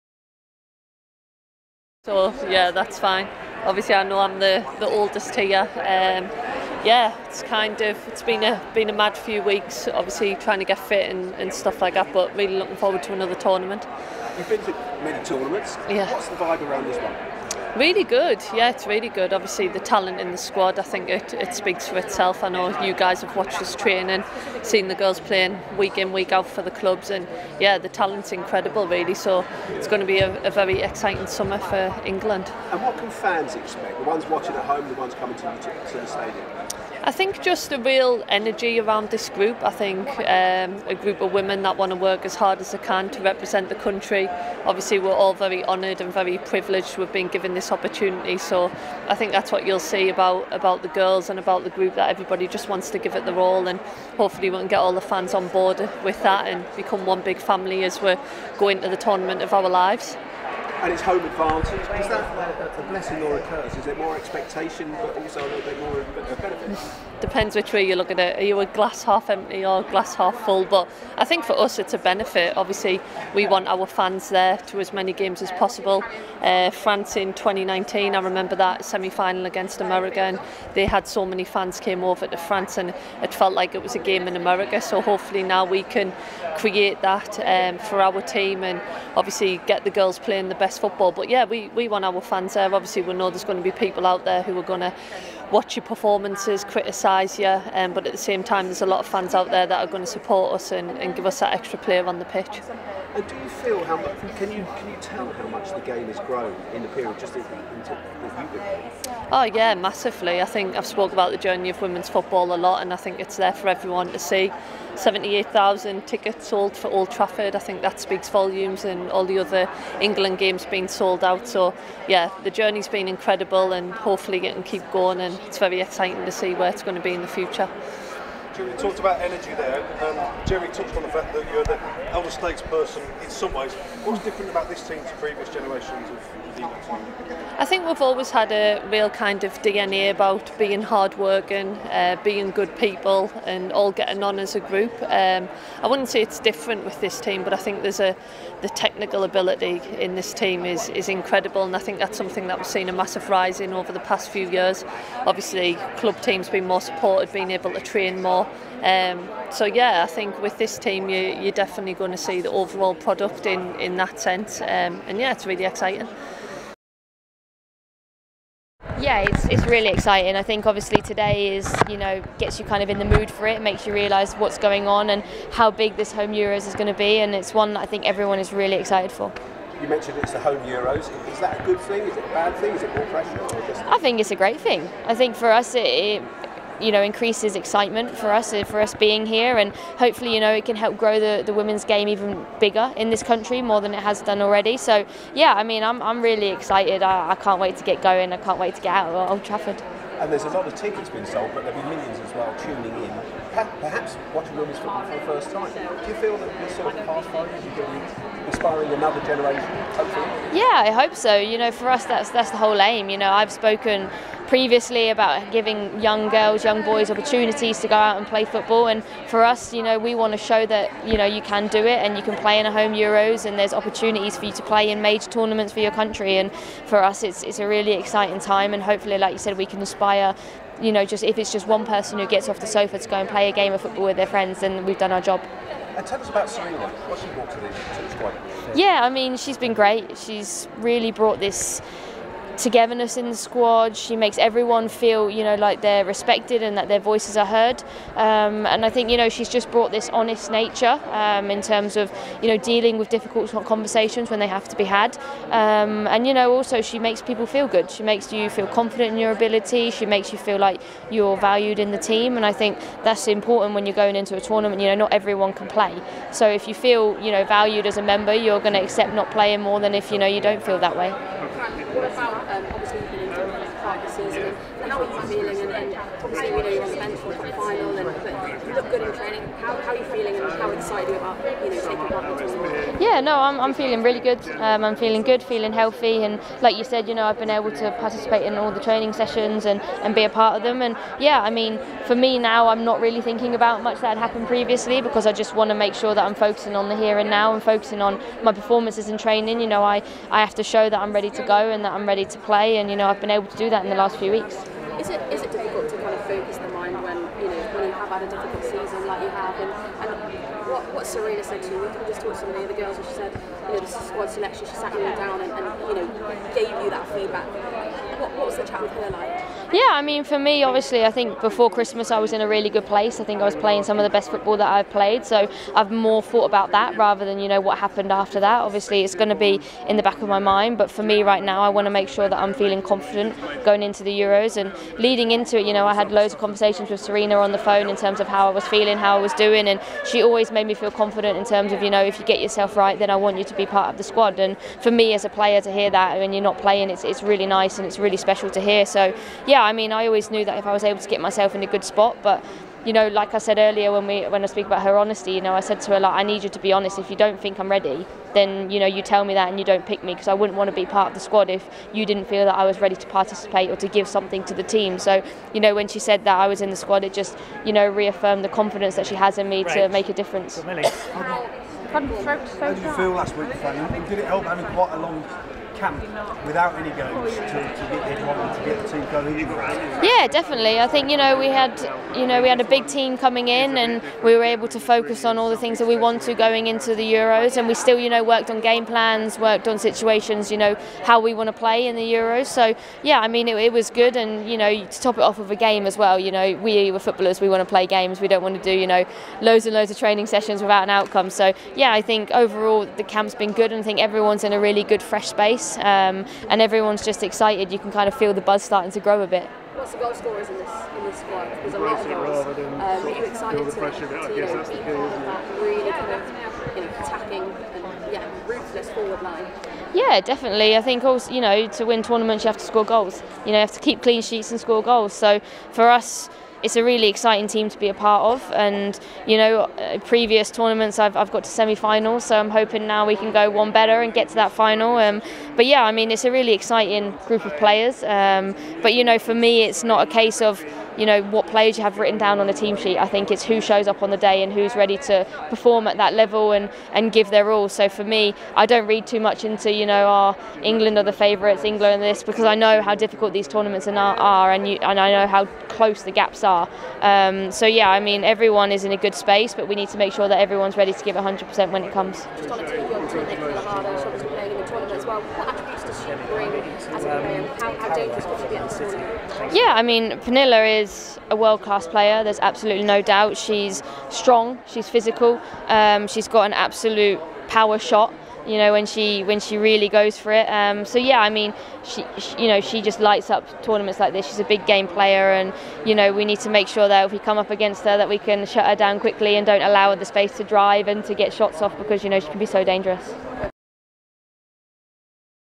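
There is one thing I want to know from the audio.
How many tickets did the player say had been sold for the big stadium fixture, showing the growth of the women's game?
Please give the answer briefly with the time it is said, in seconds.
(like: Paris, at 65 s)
78,000, at 114 s.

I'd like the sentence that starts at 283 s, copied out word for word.
Yeah, no, I'm, I'm feeling really good.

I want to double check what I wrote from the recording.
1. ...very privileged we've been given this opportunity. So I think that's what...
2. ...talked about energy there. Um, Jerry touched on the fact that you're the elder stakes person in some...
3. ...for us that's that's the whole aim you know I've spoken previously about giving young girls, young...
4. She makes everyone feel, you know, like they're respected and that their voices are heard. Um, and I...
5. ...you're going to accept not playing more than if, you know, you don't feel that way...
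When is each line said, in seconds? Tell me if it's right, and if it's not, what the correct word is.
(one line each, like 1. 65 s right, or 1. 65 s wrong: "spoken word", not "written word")
1. 46 s right
2. 128 s right
3. 211 s right
4. 243 s right
5. 268 s right.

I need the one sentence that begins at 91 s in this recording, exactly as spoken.
But yeah, we, we want our fans there.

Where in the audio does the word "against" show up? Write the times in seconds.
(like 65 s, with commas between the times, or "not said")
79 s, 487 s.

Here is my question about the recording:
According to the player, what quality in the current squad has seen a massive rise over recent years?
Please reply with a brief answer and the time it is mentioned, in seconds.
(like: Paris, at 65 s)
technical ability, at 148 s.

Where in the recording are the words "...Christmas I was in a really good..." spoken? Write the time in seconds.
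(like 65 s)
321 s.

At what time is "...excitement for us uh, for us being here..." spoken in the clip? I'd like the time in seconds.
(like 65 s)
187 s.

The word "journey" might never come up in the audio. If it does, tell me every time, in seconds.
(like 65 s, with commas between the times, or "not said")
111 s, 122 s.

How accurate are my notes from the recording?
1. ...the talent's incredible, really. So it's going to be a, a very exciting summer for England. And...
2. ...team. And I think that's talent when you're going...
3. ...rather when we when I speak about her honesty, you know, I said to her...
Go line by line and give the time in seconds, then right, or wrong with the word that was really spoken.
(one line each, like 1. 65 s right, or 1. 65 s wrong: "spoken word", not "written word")
1. 27 s right
2. 261 s wrong: "important", not "talent"
3. 353 s wrong: "earlier", not "rather".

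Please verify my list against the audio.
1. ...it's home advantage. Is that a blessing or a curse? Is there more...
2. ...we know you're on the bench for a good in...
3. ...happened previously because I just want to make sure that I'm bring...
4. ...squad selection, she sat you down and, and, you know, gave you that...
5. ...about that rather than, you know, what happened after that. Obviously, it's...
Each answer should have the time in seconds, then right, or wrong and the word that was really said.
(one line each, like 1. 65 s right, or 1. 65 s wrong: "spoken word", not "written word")
1. 60 s right
2. 275 s right
3. 294 s wrong: "focusing", not "bring"
4. 314 s right
5. 326 s right.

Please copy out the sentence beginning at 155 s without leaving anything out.
Obviously, club teams being more supported, being able to train more.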